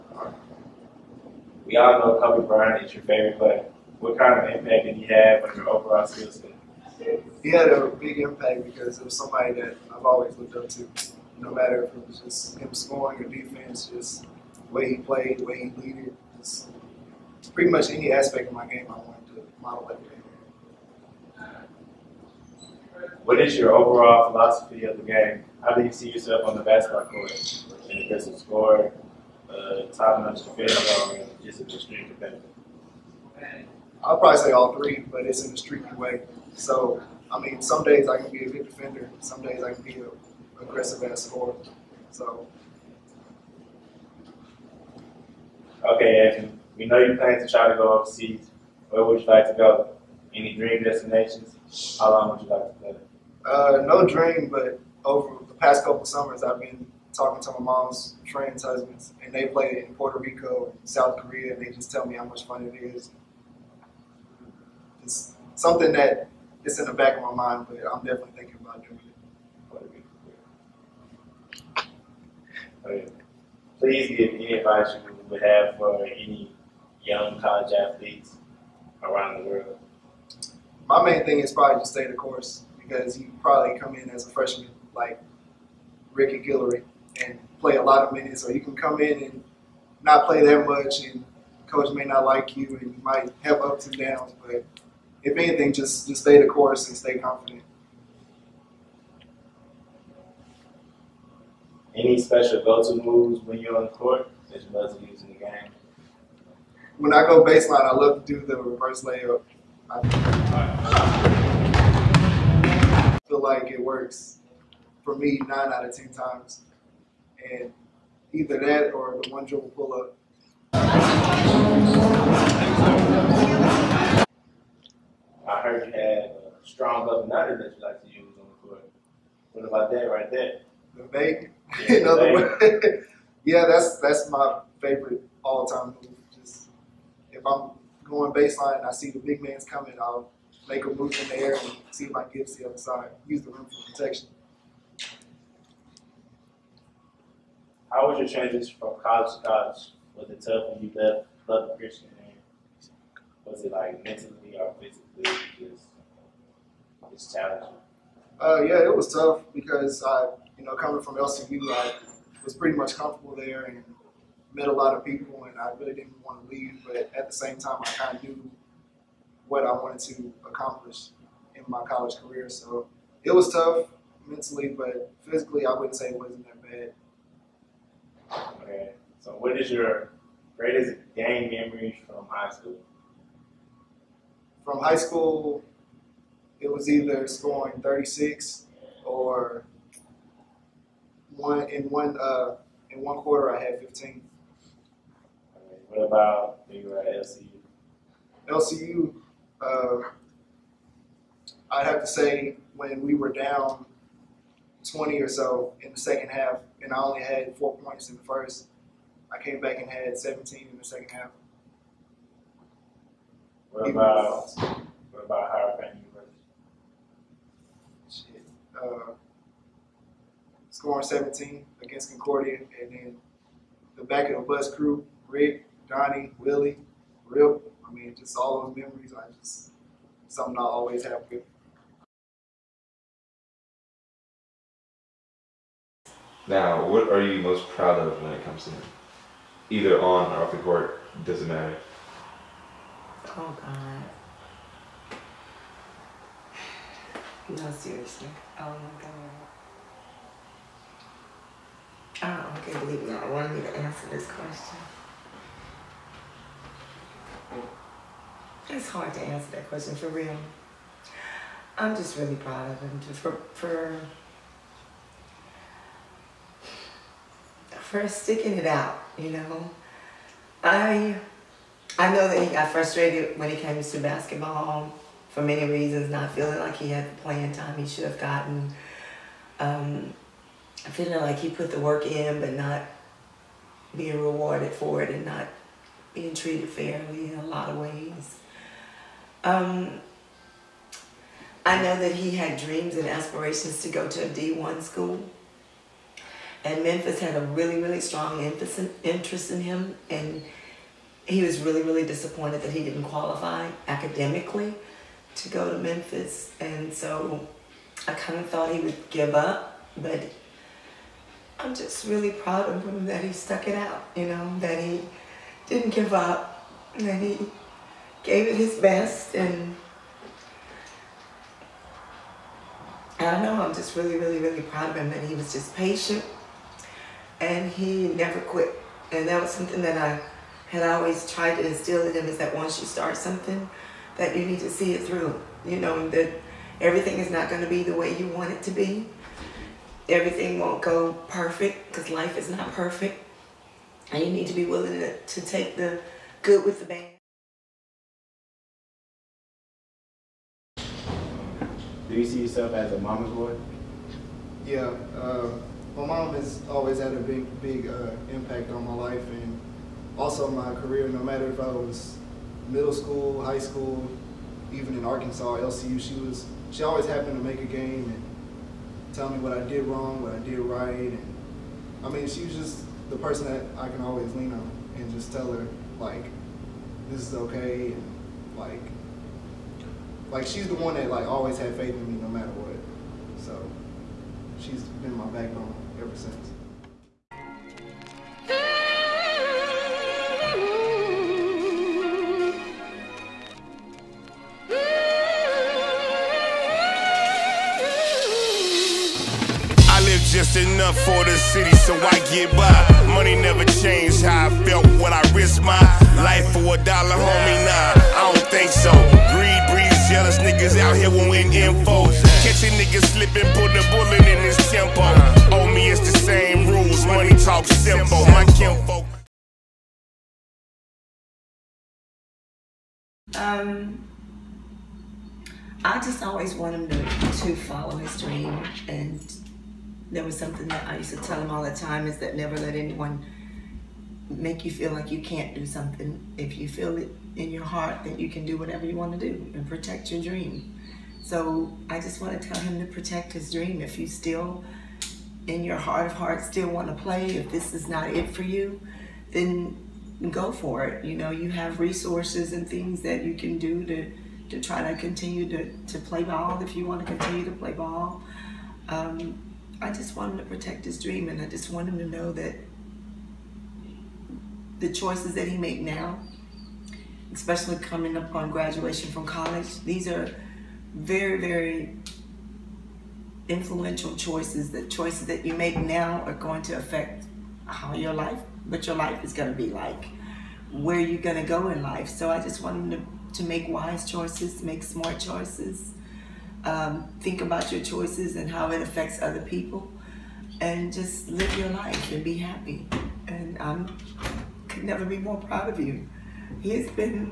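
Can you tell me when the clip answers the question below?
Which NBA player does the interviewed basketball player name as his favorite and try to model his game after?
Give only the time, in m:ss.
0:02.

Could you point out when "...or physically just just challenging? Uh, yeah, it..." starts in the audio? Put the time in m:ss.
2:34.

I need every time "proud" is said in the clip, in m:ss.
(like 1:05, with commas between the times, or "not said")
3:57, 4:22, 5:12, 5:24, 8:15.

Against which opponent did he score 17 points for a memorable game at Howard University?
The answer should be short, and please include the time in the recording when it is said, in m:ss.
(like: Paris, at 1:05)
Concordia, at 3:42.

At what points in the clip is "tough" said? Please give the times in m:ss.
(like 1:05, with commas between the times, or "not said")
2:30, 2:39, 2:53.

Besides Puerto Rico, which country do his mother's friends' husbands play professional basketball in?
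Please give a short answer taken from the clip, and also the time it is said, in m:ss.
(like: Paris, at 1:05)
South Korea, at 1:00.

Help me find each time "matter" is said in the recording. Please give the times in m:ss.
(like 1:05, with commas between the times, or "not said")
0:11, 4:01, 6:01, 6:22.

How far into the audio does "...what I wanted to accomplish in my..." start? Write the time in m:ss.
2:49.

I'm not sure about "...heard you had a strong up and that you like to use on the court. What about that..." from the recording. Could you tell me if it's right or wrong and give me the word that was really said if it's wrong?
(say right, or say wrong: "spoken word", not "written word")
right.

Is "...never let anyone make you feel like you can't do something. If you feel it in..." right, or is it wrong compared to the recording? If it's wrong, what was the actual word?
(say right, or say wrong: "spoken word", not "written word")
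right.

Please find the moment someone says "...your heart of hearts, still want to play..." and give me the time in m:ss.
7:25.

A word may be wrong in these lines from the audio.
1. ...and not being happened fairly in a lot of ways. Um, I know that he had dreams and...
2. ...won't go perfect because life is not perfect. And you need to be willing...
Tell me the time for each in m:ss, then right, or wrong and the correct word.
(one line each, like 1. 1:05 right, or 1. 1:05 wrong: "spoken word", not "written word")
1. 4:45 wrong: "treated", not "happened"
2. 5:40 right.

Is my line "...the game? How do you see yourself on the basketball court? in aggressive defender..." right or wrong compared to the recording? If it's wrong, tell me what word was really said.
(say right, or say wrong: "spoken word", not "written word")
wrong: "scorer", not "defender".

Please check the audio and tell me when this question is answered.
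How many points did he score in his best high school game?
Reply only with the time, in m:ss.
3:07.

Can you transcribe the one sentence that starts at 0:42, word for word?
So, Okay, Anthony, we know you plan to try to go overseas.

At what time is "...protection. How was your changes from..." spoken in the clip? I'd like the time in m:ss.
2:23.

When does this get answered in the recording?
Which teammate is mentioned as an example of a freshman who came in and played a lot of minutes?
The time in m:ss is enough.
1:26.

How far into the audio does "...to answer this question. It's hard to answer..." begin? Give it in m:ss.
4:13.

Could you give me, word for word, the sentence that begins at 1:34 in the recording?
But if anything, just just stay the course and stay confident.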